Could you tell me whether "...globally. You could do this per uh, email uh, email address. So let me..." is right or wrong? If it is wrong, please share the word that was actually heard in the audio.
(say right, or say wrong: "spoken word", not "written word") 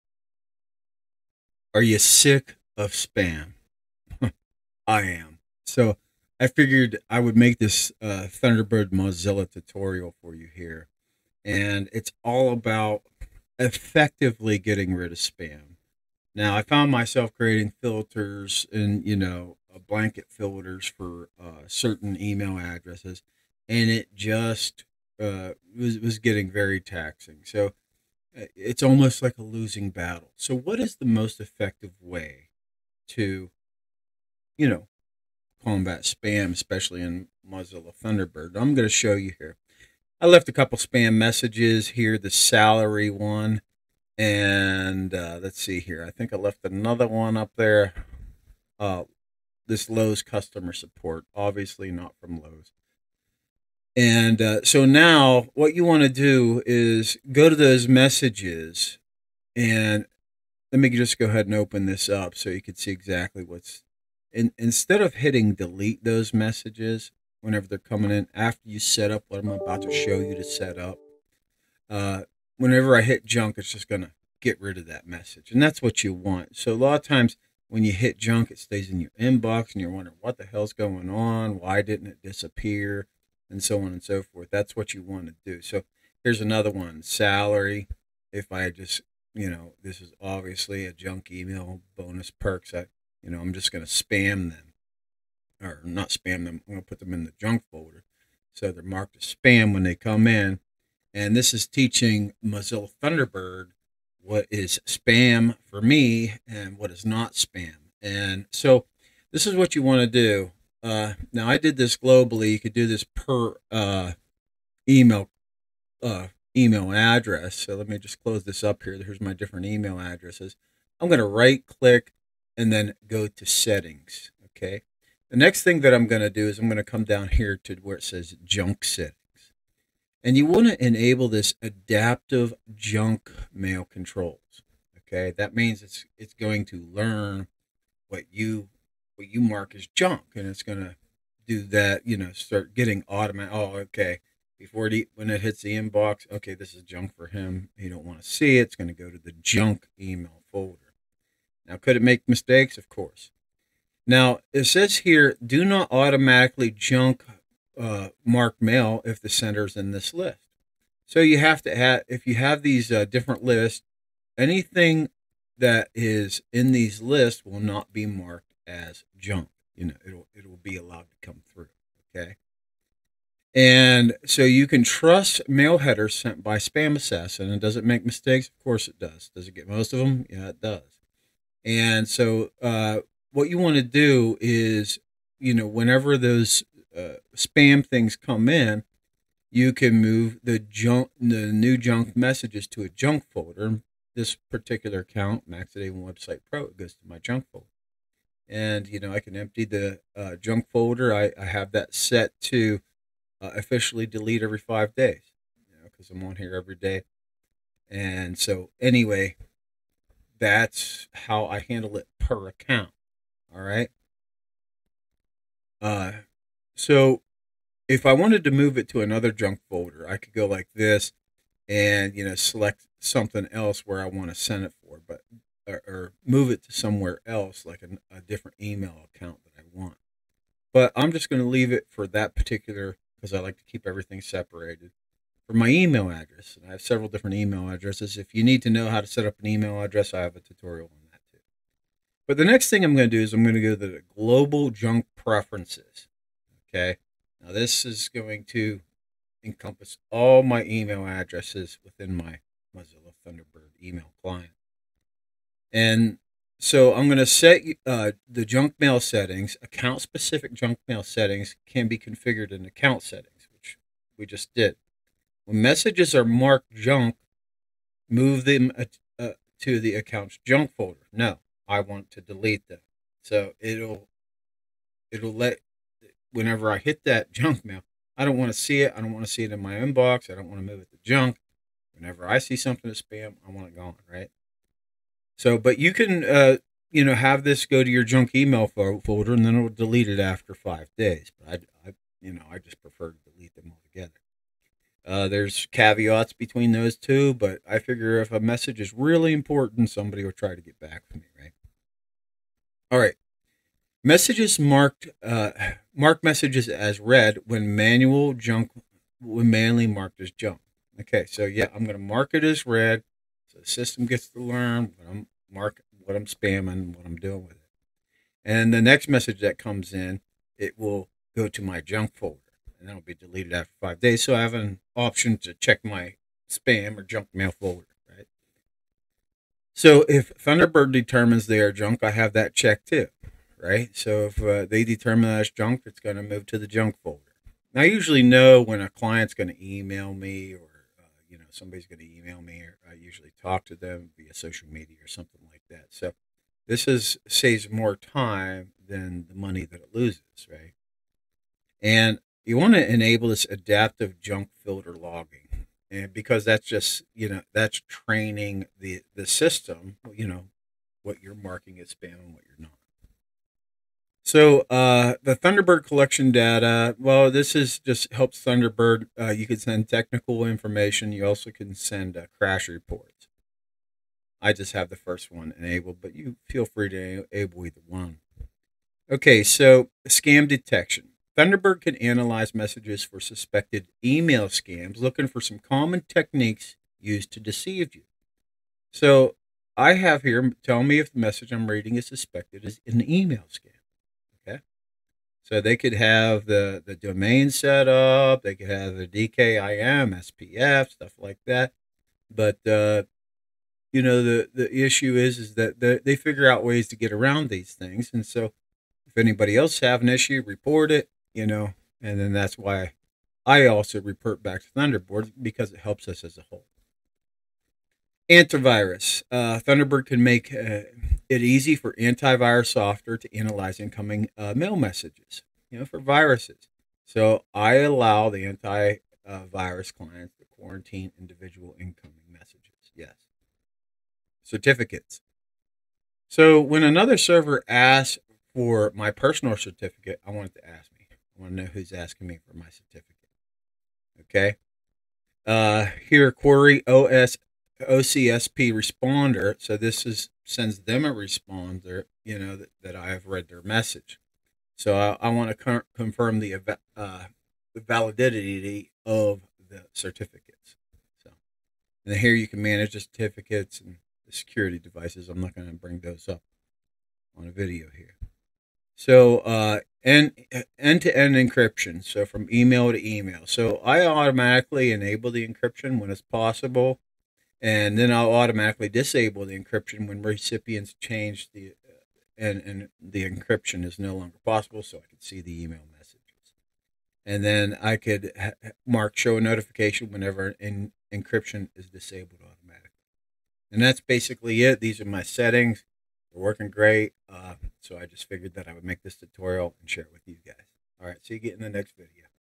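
right.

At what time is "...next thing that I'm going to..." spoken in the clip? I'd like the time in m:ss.
2:05.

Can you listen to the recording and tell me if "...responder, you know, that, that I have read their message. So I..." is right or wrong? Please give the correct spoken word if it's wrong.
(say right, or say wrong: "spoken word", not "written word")
right.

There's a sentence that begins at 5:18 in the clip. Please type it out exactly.
And the next message that comes in, it will go to my junk folder and that'll be deleted after five days.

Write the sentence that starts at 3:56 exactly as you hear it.
And I have several different email addresses.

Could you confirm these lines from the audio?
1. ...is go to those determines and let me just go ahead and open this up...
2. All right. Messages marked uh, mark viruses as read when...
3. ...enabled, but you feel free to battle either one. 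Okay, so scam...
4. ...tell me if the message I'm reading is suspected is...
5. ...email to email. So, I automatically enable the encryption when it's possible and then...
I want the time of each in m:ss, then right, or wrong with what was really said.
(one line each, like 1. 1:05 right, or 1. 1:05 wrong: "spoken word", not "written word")
1. 0:56 wrong: "messages", not "determines"
2. 5:02 wrong: "messages", not "viruses"
3. 6:15 wrong: "enable", not "battle"
4. 6:30 right
5. 7:52 right.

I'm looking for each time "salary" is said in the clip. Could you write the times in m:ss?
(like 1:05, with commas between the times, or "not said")
0:42, 1:27.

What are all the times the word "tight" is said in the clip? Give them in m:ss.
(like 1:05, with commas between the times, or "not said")
not said.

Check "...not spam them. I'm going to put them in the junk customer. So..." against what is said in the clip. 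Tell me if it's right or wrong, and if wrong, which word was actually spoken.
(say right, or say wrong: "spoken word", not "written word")
wrong: "folder", not "customer".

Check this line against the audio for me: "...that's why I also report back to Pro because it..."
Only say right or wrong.
wrong.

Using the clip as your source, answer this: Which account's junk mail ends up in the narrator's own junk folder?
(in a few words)
Maxidate Website Pro.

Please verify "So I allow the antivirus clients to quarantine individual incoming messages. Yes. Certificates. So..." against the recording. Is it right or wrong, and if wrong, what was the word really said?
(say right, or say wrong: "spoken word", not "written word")
right.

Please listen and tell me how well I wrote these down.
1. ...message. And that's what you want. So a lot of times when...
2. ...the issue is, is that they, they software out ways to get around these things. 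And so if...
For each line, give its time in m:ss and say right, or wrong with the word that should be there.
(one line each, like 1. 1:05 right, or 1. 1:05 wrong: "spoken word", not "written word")
1. 1:15 right
2. 6:44 wrong: "figure", not "software".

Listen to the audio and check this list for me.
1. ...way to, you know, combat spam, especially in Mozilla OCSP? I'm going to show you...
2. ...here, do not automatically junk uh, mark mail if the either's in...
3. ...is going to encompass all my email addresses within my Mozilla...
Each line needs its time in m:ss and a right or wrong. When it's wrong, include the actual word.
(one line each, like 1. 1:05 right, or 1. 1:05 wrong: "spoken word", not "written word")
1. 0:32 wrong: "Thunderbird", not "OCSP"
2. 2:34 wrong: "sender", not "either"
3. 4:07 right.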